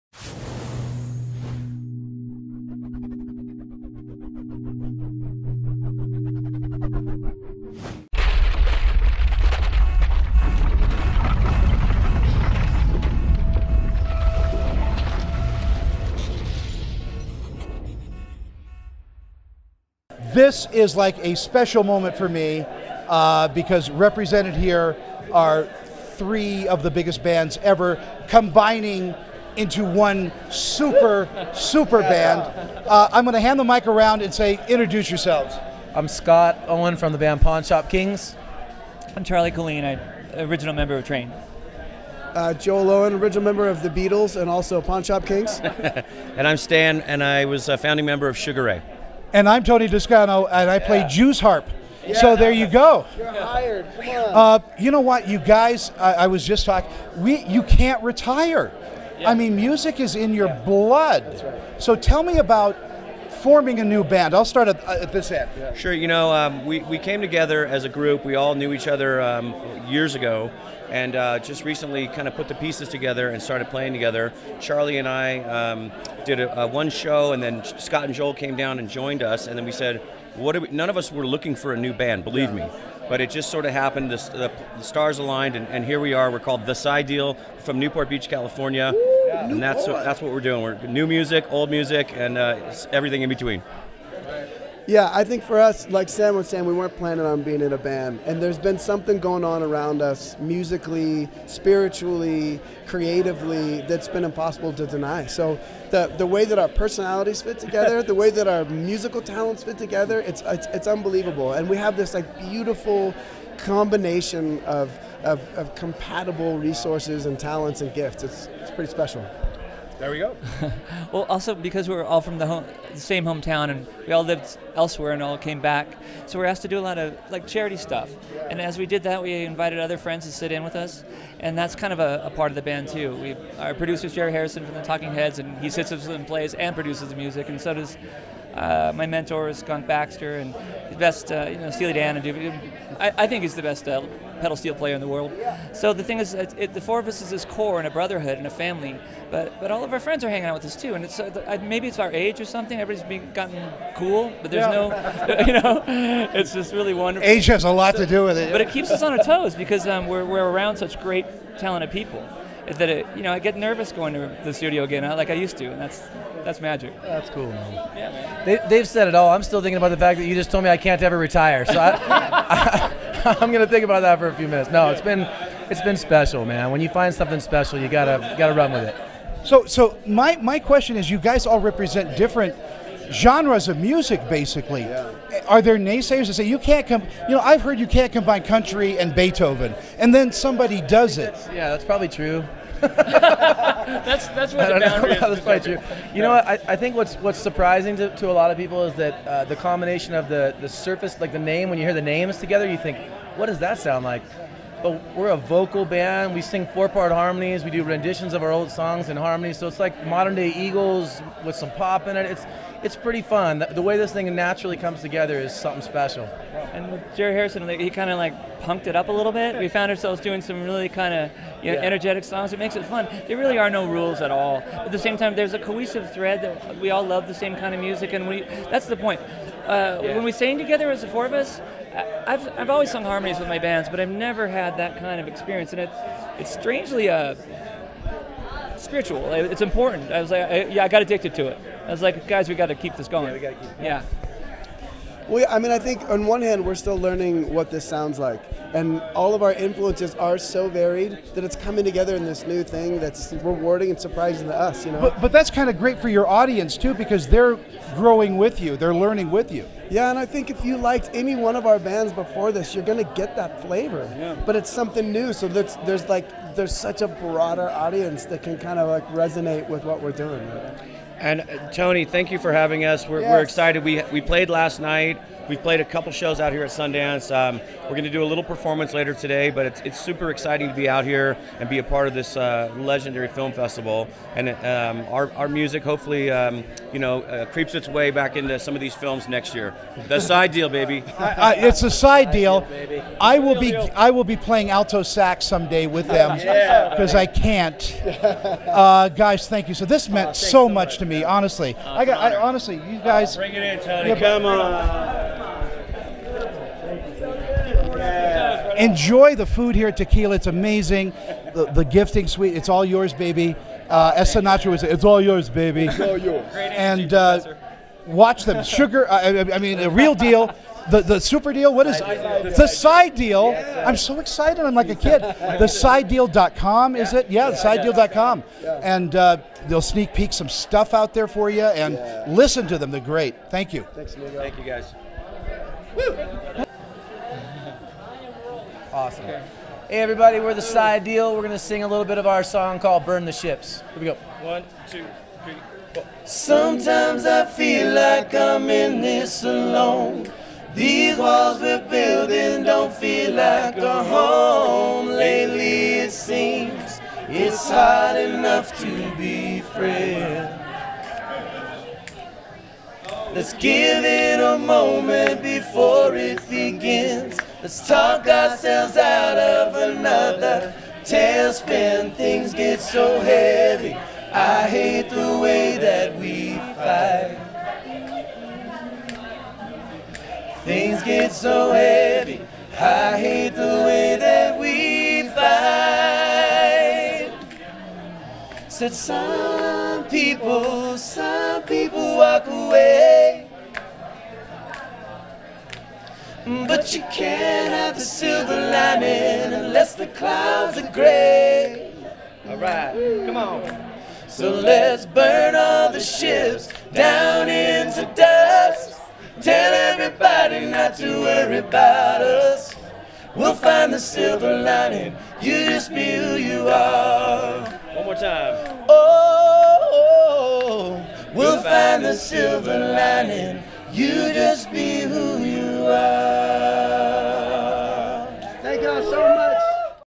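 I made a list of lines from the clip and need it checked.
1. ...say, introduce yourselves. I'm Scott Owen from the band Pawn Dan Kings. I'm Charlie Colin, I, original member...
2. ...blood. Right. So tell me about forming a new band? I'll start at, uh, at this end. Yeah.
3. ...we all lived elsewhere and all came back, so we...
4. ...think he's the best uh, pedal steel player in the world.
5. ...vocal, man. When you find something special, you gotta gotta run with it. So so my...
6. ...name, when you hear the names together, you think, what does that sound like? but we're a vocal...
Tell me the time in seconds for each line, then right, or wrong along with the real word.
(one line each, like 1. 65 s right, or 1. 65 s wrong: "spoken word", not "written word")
1. 34 s wrong: "Shop", not "Dan"
2. 60 s right
3. 124 s right
4. 143 s right
5. 175 s wrong: "special", not "vocal"
6. 201 s right.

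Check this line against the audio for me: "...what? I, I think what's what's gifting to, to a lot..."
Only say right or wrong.
wrong.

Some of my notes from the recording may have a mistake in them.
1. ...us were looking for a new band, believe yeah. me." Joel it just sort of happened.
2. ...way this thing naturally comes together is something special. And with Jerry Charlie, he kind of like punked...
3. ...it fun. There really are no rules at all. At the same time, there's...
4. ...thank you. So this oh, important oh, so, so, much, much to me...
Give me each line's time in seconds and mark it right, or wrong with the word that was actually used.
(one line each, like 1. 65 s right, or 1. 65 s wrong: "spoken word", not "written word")
1. 80 s wrong: "But", not "Joel"
2. 213 s wrong: "Harrison", not "Charlie"
3. 222 s right
4. 299 s wrong: "meant", not "important".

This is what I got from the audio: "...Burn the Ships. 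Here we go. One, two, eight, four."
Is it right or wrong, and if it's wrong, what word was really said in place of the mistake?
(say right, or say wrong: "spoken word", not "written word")
wrong: "three", not "eight".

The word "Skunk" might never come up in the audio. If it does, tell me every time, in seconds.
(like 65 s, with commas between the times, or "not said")
139 s.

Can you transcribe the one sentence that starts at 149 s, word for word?
But but all of our friends are hanging out with us too, and it's uh, maybe it's our age or something.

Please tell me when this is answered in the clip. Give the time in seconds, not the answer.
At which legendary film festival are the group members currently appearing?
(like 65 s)
276 s.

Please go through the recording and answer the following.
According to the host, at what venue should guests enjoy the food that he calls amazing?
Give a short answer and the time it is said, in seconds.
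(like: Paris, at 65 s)
Tequila, at 309 s.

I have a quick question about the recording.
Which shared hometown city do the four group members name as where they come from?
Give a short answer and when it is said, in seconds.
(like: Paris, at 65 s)
Newport Beach, California, at 87 s.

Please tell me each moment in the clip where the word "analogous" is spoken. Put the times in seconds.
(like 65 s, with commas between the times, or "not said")
not said.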